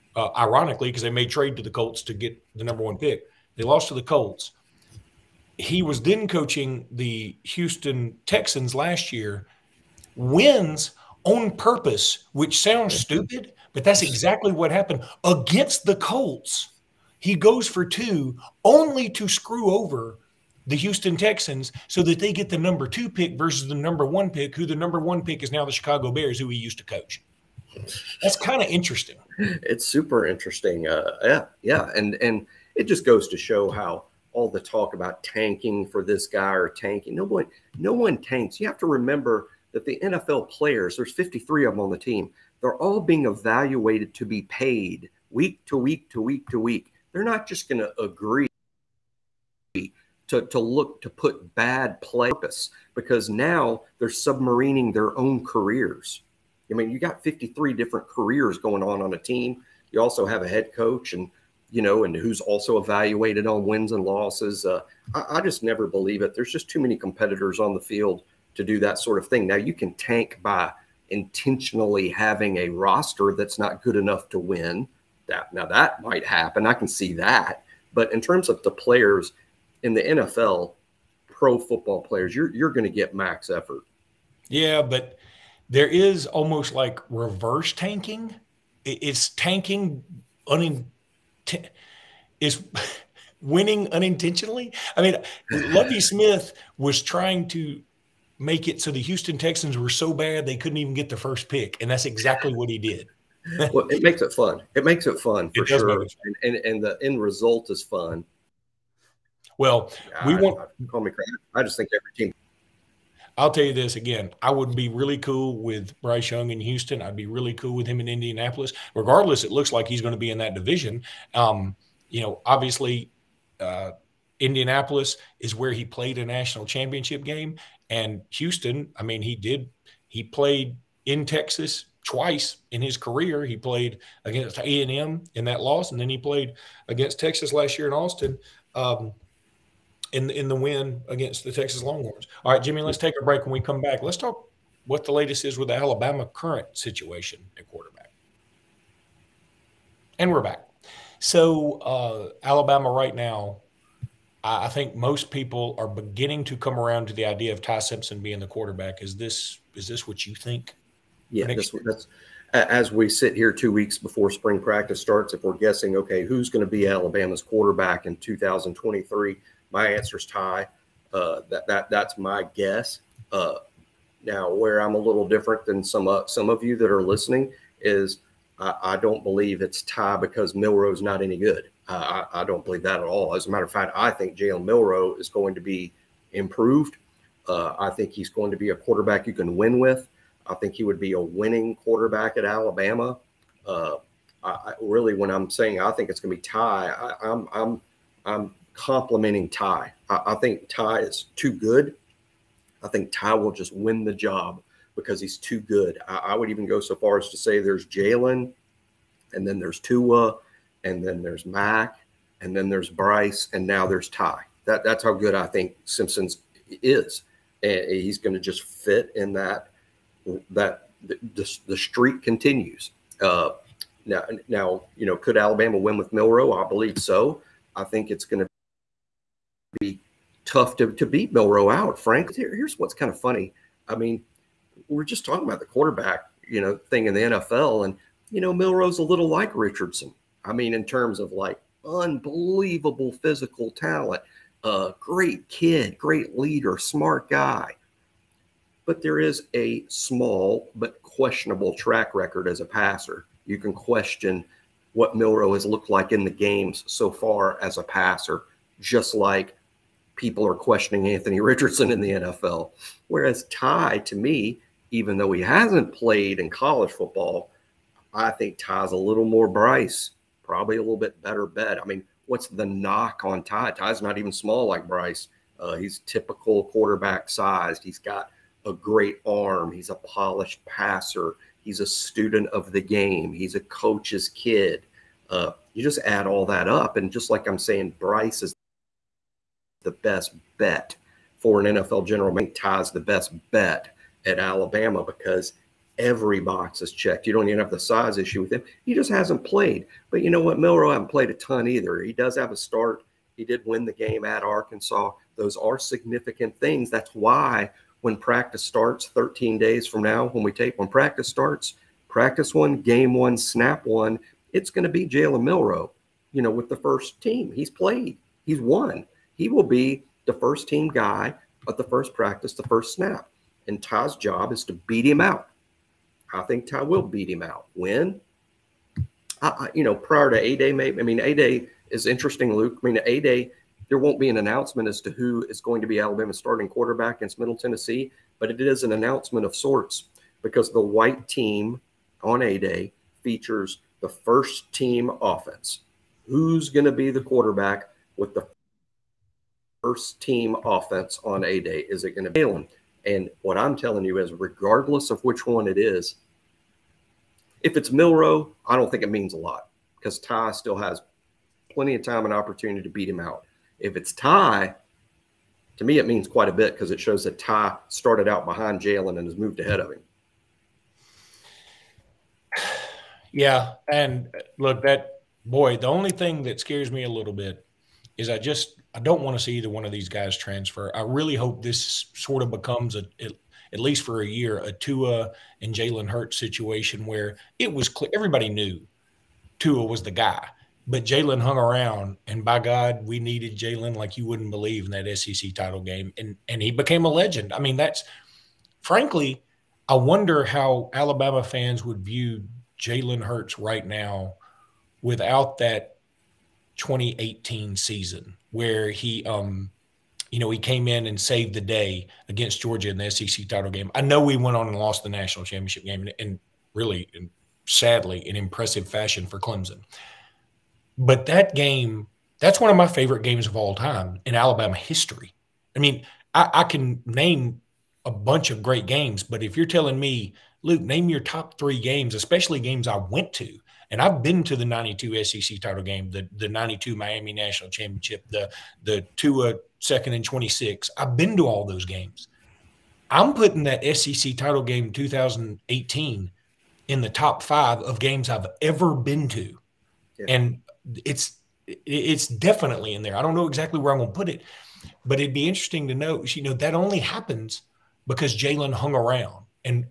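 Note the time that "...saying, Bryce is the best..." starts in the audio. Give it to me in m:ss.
4:47.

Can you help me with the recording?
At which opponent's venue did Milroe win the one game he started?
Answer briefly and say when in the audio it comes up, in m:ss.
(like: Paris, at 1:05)
Arkansas, at 5:04.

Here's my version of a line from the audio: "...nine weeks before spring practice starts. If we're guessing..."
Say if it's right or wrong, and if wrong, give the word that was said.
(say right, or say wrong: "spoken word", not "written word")
wrong: "two", not "nine".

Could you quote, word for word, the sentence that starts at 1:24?
Yeah, but there is almost like reverse tanking.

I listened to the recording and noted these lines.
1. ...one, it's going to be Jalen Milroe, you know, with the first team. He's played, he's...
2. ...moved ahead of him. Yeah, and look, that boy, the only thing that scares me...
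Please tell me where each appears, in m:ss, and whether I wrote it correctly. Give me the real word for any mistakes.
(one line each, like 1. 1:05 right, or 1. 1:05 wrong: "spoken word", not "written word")
1. 5:13 right
2. 6:09 right.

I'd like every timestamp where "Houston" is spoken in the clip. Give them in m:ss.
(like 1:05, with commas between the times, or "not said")
0:07, 0:20, 1:39, 1:56, 2:08.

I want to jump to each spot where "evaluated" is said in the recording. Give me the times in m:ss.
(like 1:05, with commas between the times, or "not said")
0:43, 1:02.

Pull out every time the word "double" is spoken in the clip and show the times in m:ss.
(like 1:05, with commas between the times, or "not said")
not said.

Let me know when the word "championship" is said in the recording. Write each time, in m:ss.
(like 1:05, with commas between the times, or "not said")
2:06, 6:55, 7:17.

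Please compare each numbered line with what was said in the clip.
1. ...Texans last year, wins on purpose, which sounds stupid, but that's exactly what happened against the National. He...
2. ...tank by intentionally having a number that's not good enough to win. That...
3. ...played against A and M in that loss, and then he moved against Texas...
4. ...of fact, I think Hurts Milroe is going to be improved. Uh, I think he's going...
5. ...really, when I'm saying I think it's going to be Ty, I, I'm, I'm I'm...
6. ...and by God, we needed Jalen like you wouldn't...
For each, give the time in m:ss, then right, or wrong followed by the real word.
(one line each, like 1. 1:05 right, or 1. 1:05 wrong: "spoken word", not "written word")
1. 0:08 wrong: "Colts", not "National"
2. 1:09 wrong: "roster", not "number"
3. 2:13 wrong: "played", not "moved"
4. 3:03 wrong: "Jalen", not "Hurts"
5. 3:14 right
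6. 6:32 right.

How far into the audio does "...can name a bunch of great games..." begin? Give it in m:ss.
7:06.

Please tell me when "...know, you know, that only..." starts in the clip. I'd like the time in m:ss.
7:35.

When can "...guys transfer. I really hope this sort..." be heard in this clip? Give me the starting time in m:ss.
6:20.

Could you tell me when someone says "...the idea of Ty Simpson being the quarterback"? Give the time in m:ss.
2:37.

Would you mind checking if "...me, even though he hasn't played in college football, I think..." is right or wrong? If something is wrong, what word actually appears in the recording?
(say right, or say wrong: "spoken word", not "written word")
right.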